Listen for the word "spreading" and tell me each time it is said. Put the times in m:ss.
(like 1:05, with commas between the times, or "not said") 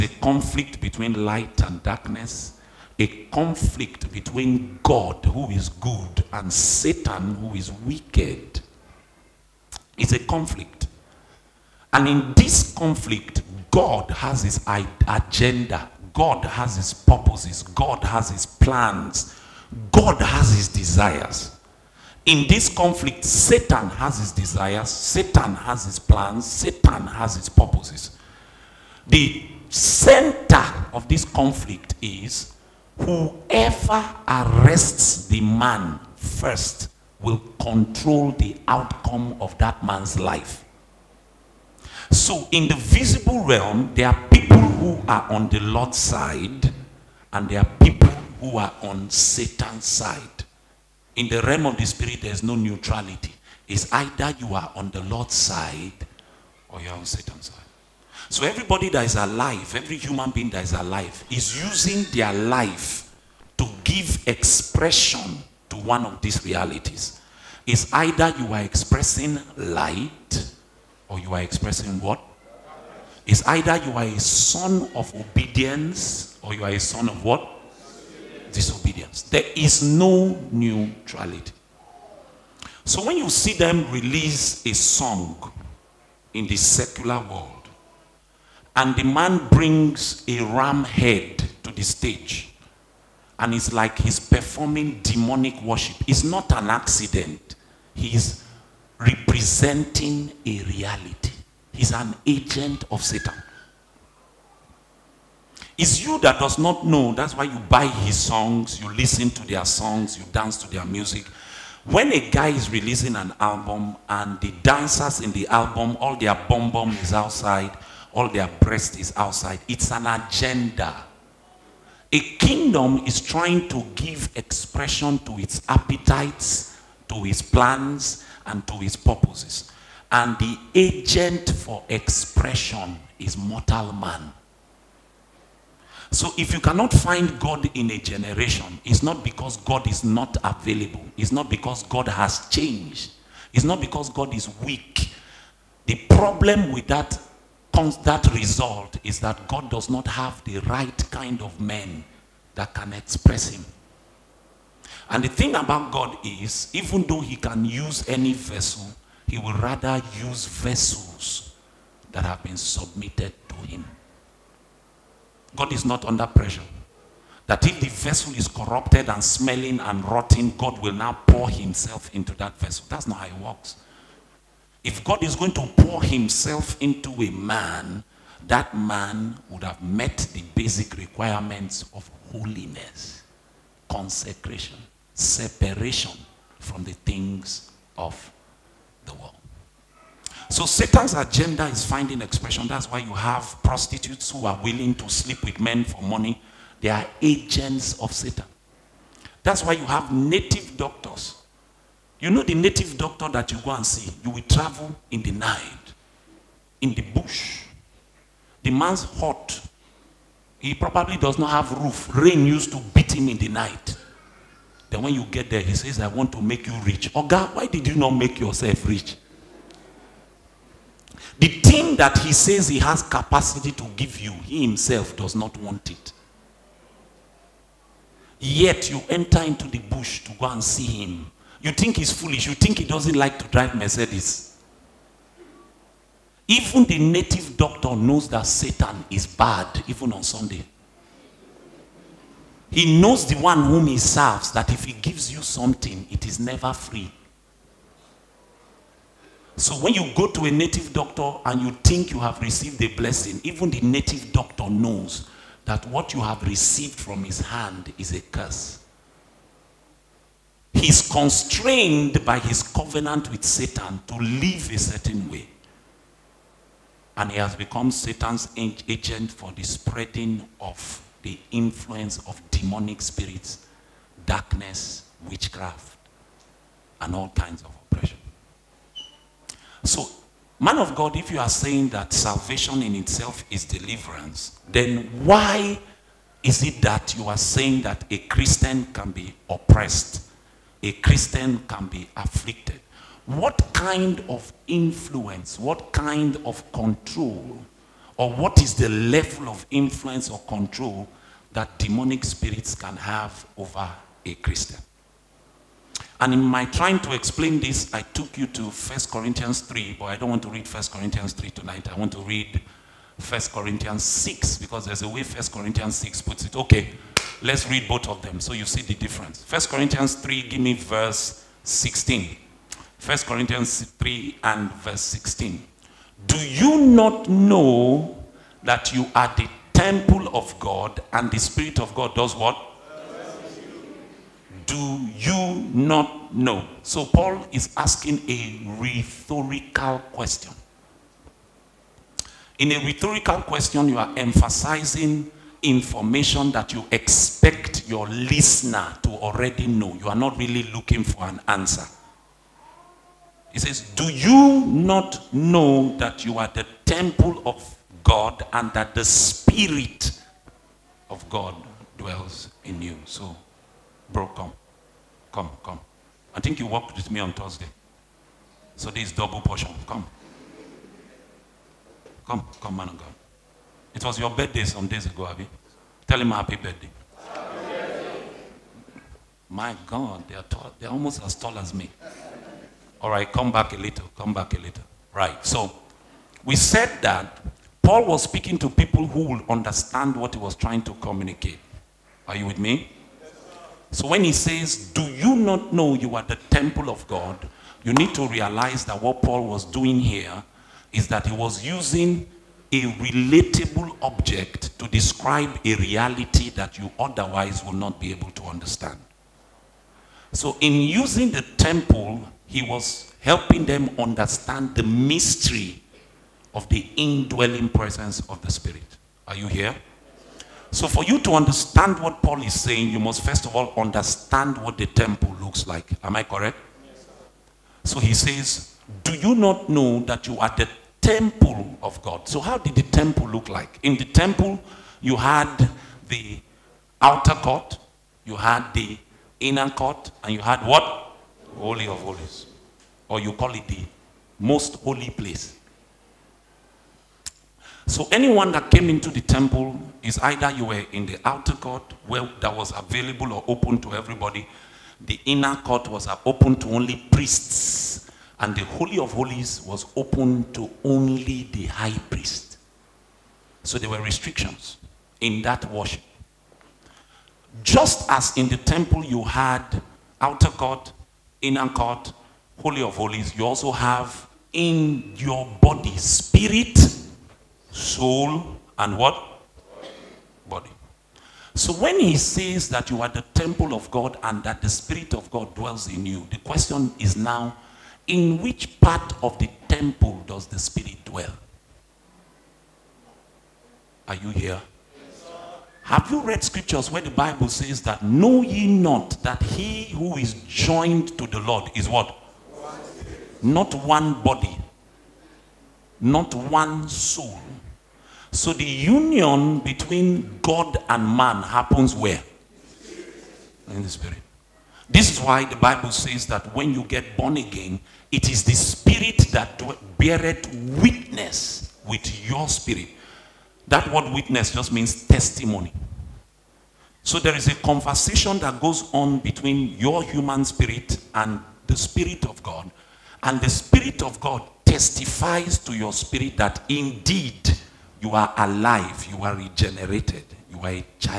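4:29.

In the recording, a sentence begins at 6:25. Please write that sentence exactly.
Right, so we said that Paul was speaking to people who would understand what he was trying to communicate.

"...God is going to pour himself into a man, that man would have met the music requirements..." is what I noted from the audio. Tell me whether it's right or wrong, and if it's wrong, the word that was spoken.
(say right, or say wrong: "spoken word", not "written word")
wrong: "basic", not "music".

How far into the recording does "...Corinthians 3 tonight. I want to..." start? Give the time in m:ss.
5:10.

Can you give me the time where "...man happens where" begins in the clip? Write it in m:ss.
8:31.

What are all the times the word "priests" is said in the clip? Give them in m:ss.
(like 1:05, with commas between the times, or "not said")
7:37, 7:42.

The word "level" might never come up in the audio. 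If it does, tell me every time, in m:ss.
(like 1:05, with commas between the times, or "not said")
4:58.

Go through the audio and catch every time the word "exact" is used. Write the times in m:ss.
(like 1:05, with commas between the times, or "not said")
not said.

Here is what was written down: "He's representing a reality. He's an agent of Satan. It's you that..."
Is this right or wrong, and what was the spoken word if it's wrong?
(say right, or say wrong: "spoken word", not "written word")
right.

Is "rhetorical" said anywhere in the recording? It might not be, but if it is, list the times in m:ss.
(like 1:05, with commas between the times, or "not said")
5:38, 5:42.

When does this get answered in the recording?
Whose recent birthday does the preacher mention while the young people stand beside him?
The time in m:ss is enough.
6:15.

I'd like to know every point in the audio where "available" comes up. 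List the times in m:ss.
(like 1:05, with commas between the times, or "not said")
2:20, 7:32.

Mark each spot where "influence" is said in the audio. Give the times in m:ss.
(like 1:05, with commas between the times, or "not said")
4:31, 4:54, 4:59.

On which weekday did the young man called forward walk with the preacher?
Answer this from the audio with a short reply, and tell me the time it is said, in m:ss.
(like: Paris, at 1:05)
Thursday, at 6:07.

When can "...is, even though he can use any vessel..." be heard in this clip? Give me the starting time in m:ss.
2:36.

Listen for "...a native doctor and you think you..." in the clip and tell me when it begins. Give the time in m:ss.
4:10.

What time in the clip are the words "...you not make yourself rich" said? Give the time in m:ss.
3:37.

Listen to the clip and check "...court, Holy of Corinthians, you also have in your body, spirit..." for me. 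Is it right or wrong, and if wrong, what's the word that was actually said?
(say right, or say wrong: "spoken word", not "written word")
wrong: "Holies", not "Corinthians".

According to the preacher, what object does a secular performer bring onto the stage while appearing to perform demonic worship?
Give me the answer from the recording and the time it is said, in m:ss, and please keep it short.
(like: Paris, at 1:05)
Ram head, at 1:30.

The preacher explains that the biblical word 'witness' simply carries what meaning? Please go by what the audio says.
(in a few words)
Testimony.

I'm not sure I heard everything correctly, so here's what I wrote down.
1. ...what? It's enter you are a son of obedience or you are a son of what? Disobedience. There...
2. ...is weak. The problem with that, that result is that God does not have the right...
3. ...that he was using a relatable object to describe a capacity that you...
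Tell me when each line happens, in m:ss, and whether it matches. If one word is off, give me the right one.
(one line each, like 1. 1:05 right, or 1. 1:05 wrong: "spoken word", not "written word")
1. 1:11 wrong: "either", not "enter"
2. 2:24 right
3. 6:41 wrong: "reality", not "capacity".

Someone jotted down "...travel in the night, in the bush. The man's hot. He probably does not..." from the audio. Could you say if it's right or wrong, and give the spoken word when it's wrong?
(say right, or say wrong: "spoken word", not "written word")
right.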